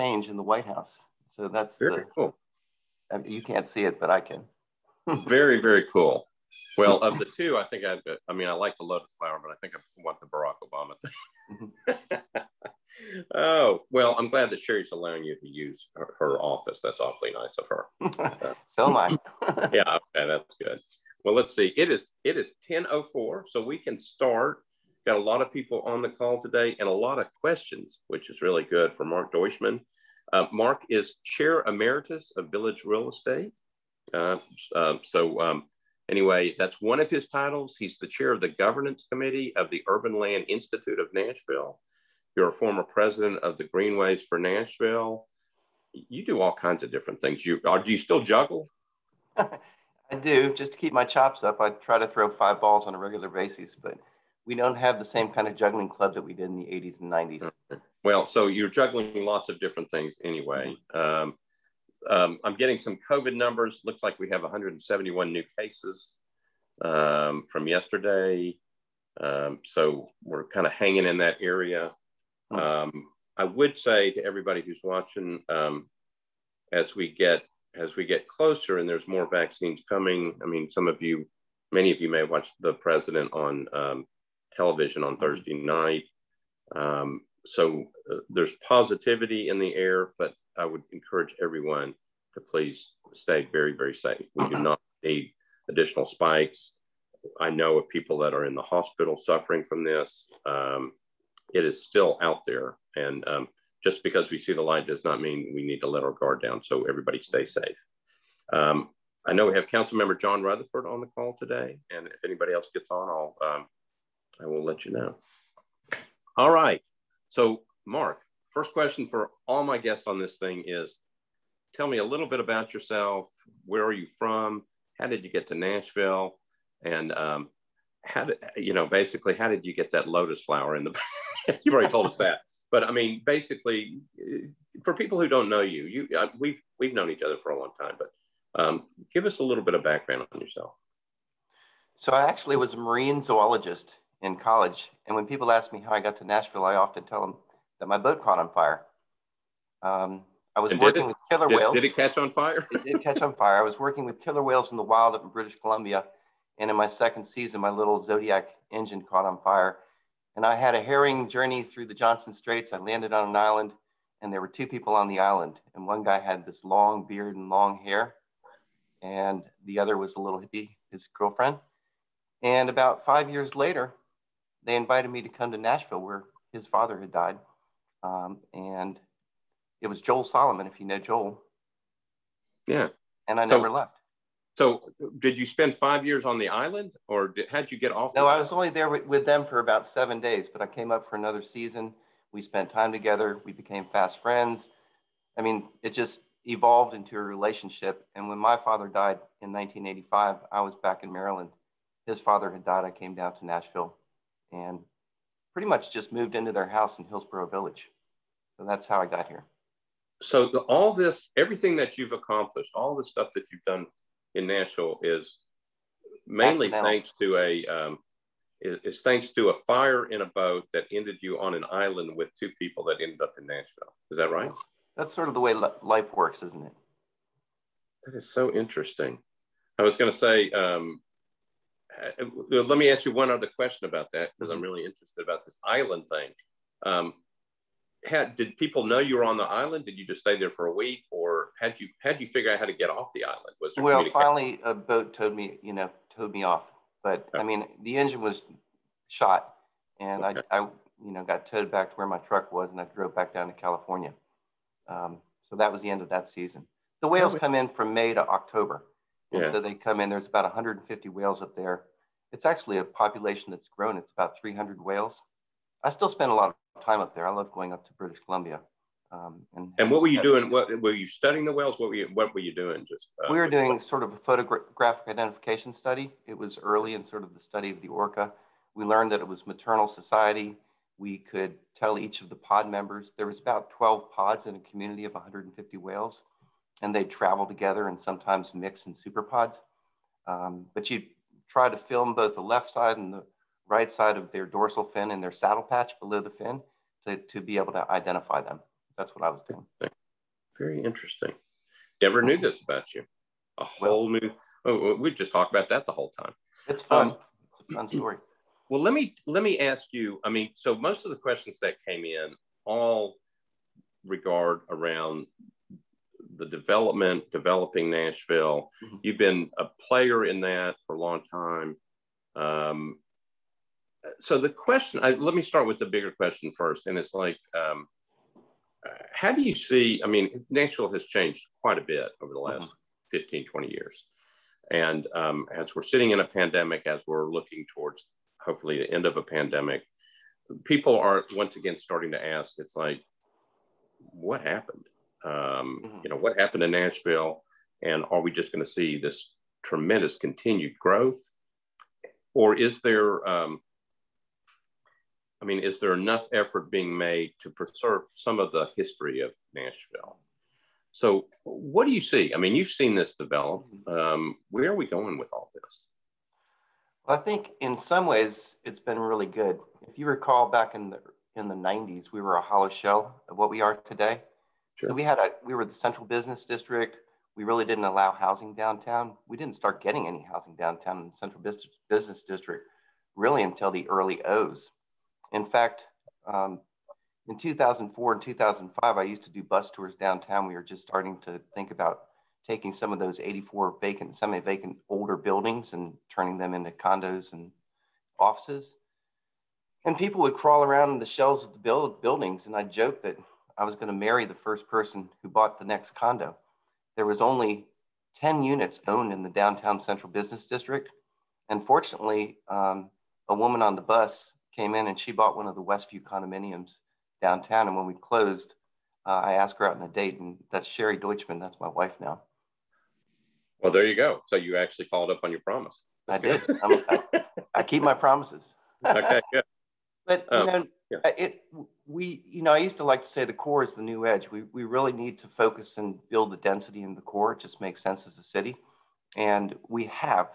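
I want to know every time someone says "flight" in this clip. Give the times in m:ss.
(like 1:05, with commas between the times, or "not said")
not said.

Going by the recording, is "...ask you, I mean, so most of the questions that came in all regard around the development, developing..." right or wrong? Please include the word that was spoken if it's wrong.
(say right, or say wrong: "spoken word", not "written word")
right.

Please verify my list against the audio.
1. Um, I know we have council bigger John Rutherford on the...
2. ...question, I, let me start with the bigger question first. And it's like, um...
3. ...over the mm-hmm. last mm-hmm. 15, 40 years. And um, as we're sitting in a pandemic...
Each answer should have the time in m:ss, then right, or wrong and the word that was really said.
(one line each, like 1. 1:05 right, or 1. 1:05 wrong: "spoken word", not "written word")
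1. 1:48 wrong: "member", not "bigger"
2. 5:24 right
3. 5:32 wrong: "20", not "40".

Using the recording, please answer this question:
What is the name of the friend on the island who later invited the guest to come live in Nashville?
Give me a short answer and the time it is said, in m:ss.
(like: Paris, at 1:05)
Joel Solomon, at 3:00.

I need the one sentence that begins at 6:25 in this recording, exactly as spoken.
In fact, um, in 2004 and 2005, I used to do bus tours downtown.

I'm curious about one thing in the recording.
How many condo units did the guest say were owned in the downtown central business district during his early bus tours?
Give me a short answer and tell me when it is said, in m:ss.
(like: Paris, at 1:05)
10, at 6:48.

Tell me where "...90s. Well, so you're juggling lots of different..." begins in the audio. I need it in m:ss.
0:57.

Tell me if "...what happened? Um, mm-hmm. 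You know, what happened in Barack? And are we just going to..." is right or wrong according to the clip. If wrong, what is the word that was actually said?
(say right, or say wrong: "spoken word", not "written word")
wrong: "Nashville", not "Barack".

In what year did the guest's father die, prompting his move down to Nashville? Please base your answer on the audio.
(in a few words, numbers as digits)
1985.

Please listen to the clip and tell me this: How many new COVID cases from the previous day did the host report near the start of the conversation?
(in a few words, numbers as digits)
171.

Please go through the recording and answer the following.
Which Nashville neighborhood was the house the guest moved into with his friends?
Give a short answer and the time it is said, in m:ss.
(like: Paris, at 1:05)
Hillsboro Village, at 3:27.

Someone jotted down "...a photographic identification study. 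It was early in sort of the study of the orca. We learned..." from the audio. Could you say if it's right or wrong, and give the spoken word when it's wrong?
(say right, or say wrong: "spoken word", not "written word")
right.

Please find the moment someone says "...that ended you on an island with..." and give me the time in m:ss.
3:40.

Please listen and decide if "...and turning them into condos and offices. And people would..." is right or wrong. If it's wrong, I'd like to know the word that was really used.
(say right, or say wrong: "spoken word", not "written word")
right.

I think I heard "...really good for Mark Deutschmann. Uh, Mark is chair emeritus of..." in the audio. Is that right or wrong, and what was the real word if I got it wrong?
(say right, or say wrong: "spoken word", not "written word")
right.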